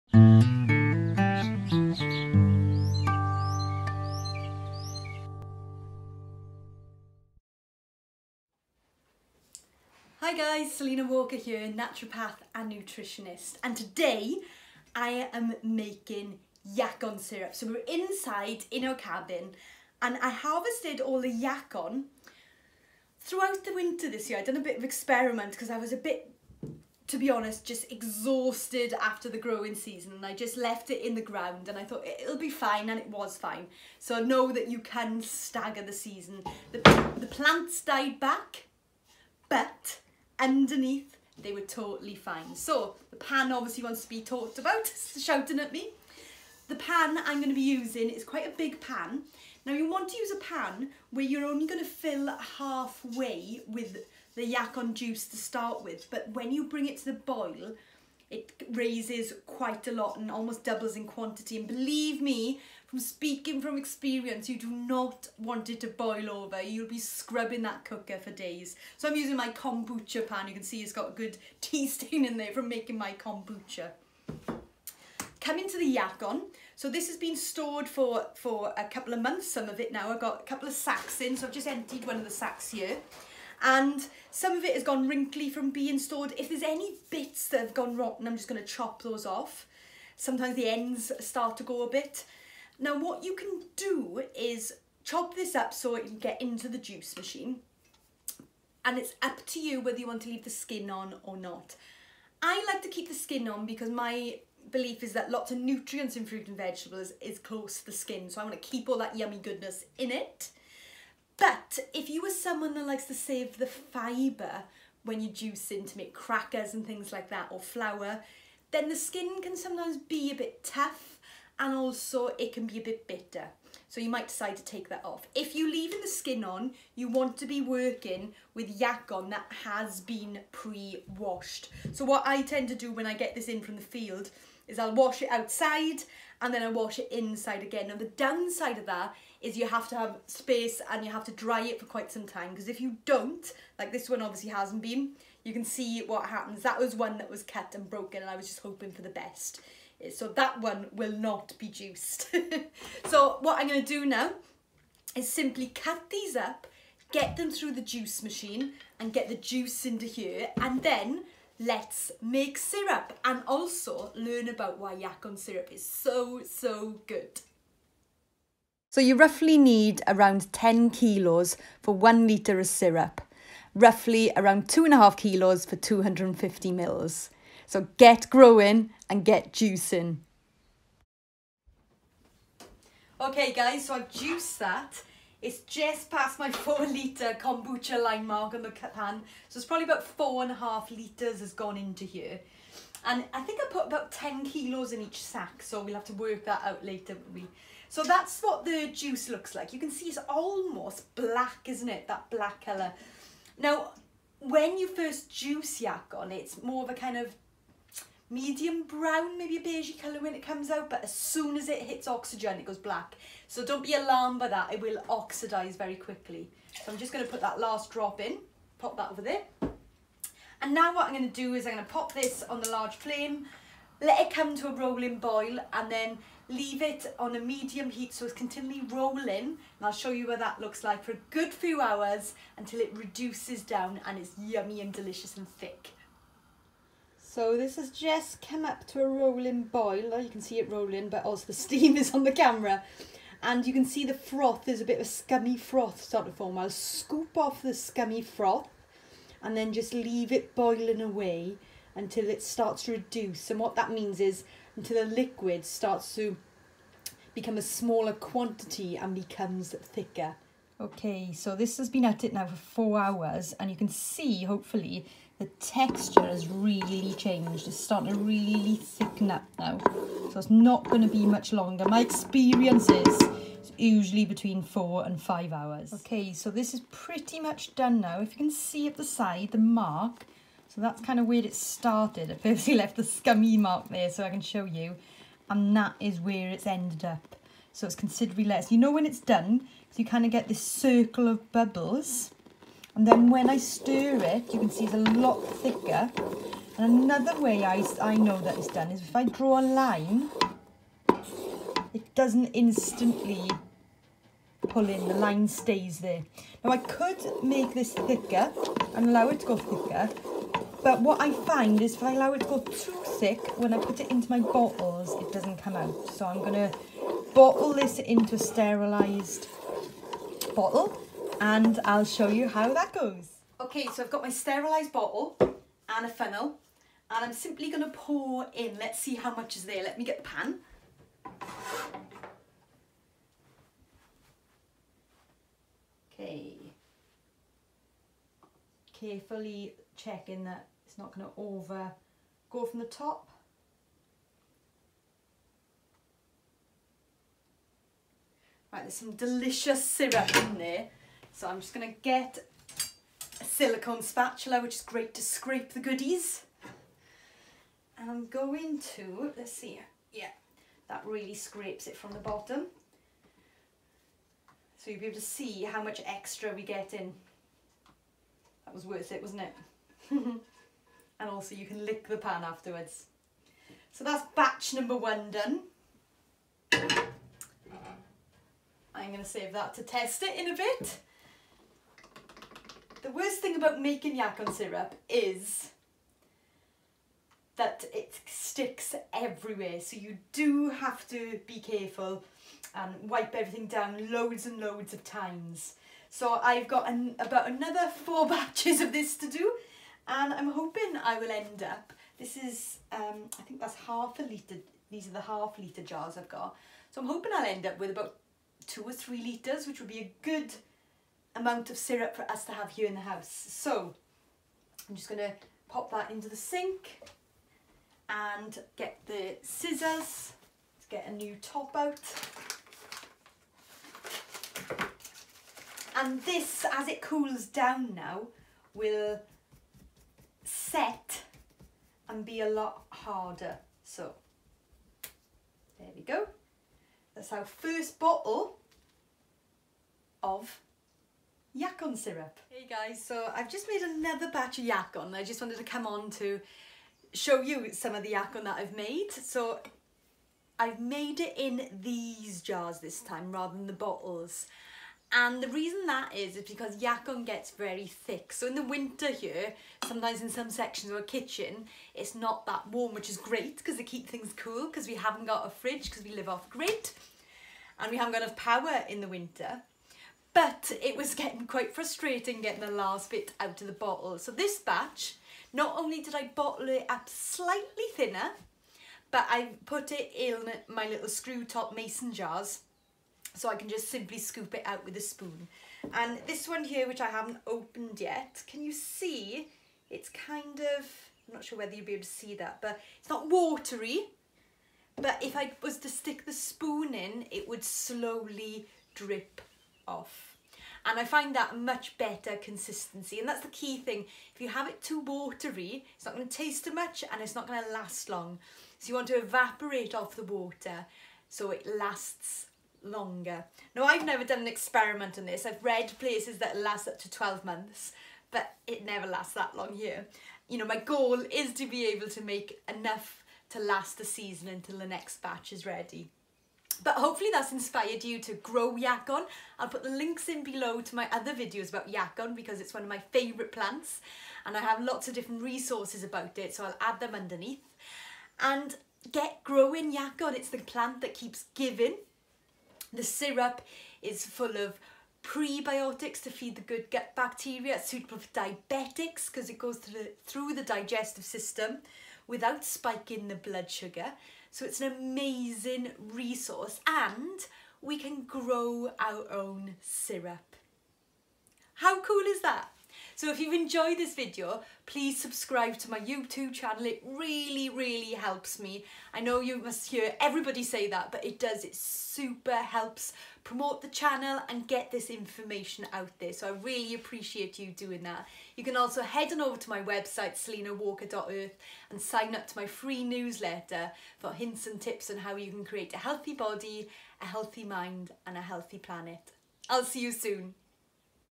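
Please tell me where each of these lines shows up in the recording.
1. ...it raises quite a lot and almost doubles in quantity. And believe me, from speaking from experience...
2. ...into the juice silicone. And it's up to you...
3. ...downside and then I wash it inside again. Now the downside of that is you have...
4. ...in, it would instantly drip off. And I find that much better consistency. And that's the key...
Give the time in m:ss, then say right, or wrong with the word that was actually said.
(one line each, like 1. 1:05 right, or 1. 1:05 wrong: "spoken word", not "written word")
1. 0:58 right
2. 1:36 wrong: "machine", not "silicone"
3. 2:15 wrong: "outside", not "downside"
4. 8:16 wrong: "slowly", not "instantly".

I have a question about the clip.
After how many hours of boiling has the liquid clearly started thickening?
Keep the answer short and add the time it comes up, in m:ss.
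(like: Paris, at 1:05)
4, at 4:22.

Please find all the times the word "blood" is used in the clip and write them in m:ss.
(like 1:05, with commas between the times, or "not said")
9:13.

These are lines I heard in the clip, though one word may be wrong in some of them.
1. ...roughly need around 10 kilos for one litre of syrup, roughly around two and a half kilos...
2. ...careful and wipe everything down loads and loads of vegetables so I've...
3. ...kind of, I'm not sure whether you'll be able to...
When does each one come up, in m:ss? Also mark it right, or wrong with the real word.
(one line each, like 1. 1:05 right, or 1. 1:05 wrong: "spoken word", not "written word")
1. 2:49 right
2. 6:31 wrong: "times", not "vegetables"
3. 8:10 right.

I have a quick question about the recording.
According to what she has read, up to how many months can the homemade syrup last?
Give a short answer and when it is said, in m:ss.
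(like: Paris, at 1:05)
12, at 8:37.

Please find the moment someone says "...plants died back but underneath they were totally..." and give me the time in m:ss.
0:37.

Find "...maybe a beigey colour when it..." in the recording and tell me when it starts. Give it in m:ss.
3:29.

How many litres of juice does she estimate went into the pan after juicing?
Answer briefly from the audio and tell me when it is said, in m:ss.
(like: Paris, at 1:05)
4.5, at 3:10.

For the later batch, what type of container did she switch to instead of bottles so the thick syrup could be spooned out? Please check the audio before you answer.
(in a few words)
mason jars.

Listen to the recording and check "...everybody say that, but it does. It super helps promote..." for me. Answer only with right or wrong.
right.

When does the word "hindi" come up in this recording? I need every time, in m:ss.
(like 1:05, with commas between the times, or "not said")
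not said.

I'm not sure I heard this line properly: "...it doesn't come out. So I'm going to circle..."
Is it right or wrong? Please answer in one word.
wrong.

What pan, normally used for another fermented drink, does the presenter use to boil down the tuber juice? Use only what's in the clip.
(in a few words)
kombucha pan.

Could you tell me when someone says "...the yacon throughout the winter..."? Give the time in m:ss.
0:21.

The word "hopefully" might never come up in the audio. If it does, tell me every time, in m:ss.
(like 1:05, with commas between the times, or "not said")
4:24, 8:46.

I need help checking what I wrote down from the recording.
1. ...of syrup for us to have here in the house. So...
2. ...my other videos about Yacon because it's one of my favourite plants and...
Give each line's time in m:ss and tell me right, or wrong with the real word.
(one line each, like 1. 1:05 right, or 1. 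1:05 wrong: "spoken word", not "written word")
1. 6:51 right
2. 8:50 right.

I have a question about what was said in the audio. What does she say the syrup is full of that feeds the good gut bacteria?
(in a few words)
prebiotics.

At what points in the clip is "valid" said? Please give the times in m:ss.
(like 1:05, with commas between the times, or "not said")
not said.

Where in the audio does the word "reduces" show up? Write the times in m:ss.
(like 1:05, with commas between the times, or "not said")
3:52, 4:12.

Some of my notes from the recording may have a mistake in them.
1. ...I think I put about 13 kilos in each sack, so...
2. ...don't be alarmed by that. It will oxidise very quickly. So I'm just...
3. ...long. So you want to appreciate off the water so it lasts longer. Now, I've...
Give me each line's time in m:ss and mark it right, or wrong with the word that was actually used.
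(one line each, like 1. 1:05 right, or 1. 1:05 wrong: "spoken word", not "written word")
1. 3:13 wrong: "10", not "13"
2. 3:33 right
3. 8:28 wrong: "evaporate", not "appreciate".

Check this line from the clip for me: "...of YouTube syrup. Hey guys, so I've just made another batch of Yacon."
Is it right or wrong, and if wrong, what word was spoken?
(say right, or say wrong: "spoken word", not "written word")
wrong: "Yacon", not "YouTube".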